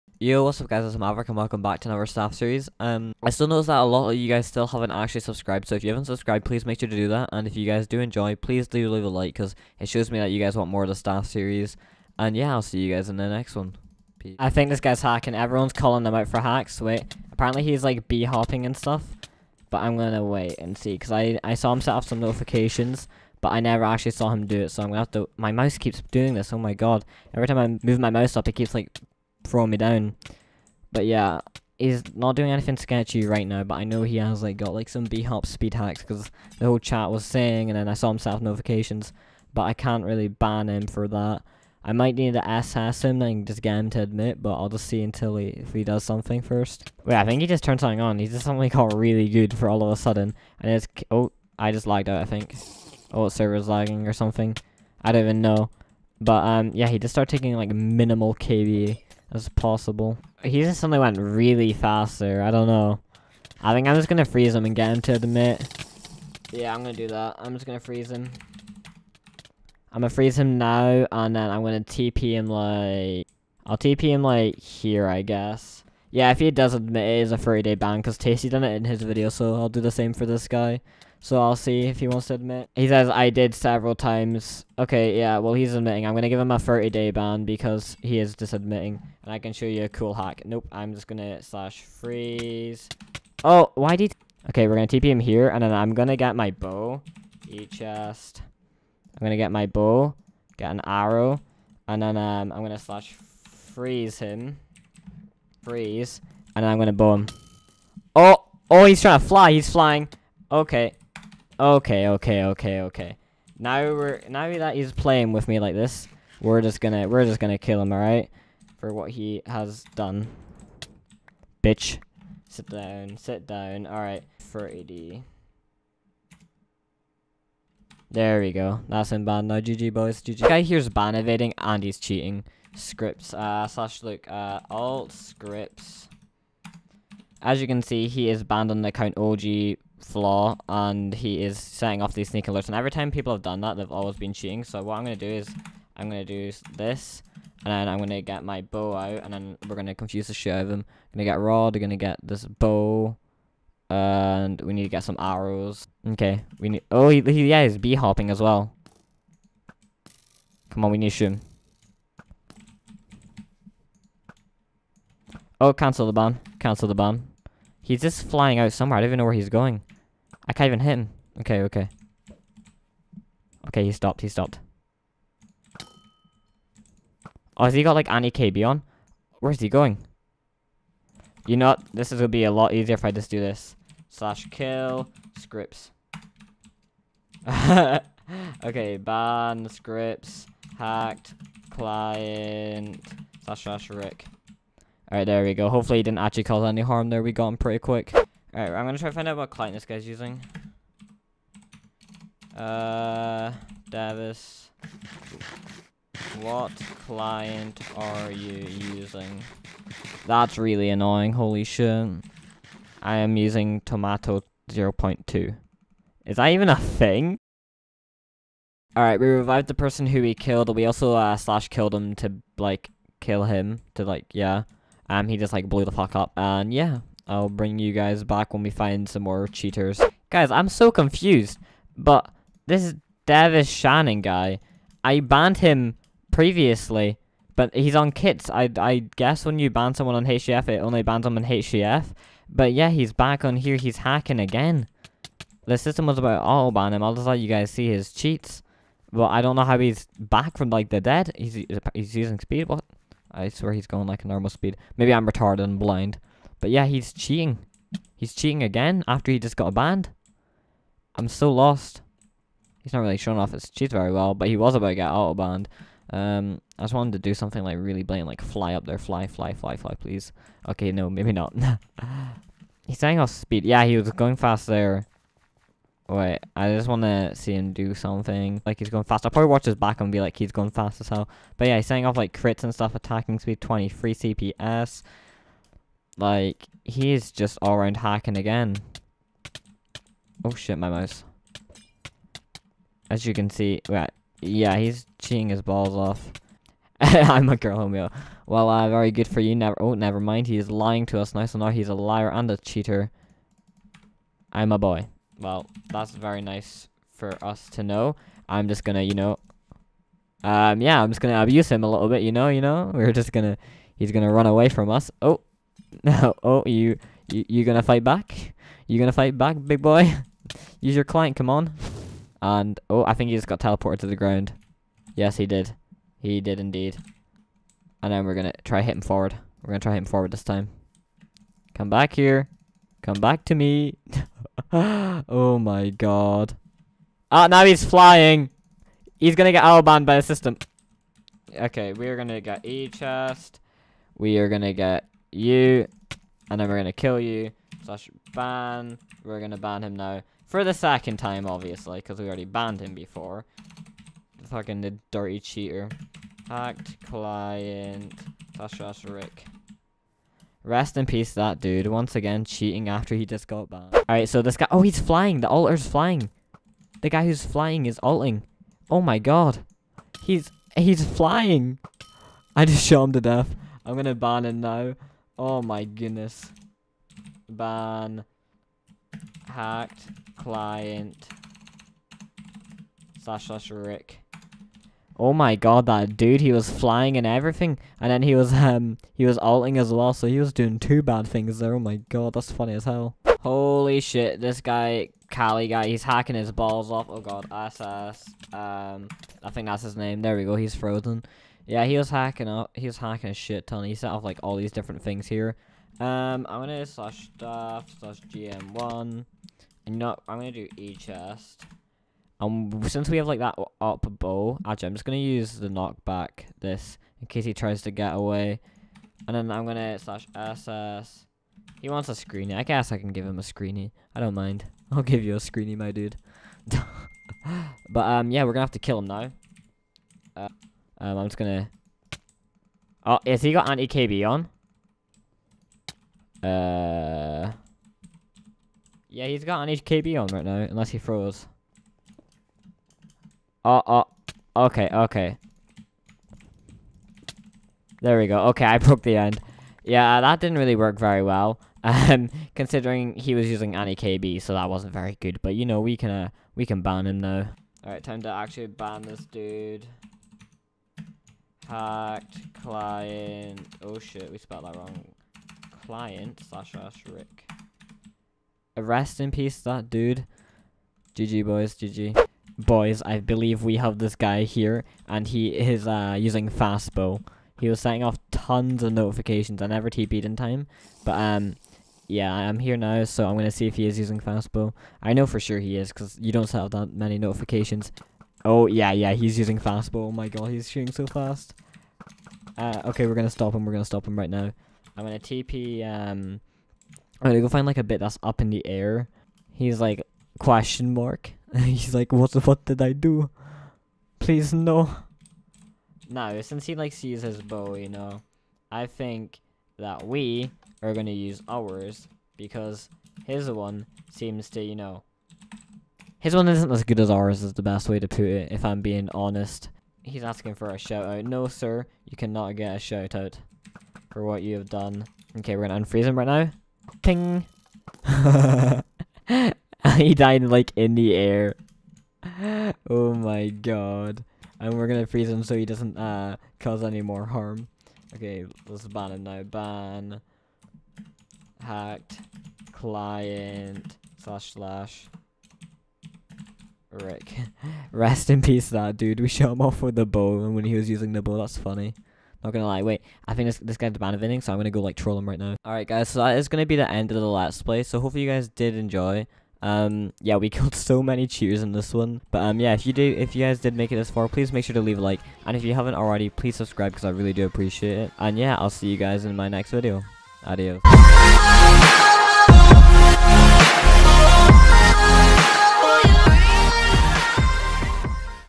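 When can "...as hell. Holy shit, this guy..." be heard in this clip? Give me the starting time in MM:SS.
06:32.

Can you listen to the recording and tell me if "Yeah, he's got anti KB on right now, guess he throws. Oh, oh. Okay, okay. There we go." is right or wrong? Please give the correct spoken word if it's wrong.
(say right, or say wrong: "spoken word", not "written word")
wrong: "unless", not "guess".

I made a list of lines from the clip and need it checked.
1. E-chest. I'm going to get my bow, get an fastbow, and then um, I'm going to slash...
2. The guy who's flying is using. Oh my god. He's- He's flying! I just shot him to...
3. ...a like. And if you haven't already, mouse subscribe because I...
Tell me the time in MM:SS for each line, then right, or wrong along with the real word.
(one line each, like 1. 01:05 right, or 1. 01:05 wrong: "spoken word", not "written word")
1. 01:37 wrong: "arrow", not "fastbow"
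2. 06:07 wrong: "alting", not "using"
3. 09:24 wrong: "please", not "mouse".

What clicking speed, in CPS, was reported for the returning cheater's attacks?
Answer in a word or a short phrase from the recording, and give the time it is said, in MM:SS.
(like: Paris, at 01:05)
23, at 04:43.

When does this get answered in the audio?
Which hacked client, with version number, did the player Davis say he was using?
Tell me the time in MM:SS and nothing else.
03:33.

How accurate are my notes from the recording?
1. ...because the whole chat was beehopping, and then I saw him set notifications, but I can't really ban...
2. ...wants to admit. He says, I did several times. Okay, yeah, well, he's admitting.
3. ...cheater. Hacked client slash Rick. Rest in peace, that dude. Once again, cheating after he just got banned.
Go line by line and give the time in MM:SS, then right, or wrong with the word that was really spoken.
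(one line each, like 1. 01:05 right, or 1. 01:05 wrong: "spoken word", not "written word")
1. 00:36 wrong: "saying", not "beehopping"
2. 01:22 right
3. 05:55 right.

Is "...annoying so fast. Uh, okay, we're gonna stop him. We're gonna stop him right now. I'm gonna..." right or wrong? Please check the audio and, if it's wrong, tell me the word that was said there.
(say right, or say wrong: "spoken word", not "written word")
wrong: "shooting", not "annoying".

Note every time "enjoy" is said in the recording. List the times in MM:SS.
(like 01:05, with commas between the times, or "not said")
00:07, 09:18.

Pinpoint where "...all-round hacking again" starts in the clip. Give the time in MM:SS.
04:47.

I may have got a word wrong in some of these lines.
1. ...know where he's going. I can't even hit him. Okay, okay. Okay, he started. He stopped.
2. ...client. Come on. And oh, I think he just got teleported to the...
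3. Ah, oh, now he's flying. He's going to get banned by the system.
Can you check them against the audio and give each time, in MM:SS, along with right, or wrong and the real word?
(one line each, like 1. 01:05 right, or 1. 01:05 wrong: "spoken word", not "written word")
1. 02:49 wrong: "stopped", not "started"
2. 05:21 right
3. 05:37 right.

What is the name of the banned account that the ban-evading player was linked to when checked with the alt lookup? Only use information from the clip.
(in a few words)
OG flaw.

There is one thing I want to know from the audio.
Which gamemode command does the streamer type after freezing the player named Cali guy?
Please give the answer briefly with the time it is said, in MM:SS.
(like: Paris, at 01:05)
GM1, at 06:48.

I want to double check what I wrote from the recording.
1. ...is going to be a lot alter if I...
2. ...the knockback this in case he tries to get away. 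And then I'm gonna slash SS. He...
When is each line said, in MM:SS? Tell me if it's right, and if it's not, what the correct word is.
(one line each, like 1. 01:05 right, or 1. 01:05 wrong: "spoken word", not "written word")
1. 03:02 wrong: "easier", not "alter"
2. 06:55 right.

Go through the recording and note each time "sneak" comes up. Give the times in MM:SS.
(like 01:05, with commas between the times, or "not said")
02:22.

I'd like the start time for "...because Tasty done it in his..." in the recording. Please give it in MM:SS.
01:17.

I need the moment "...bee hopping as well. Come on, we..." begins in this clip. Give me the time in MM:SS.
02:37.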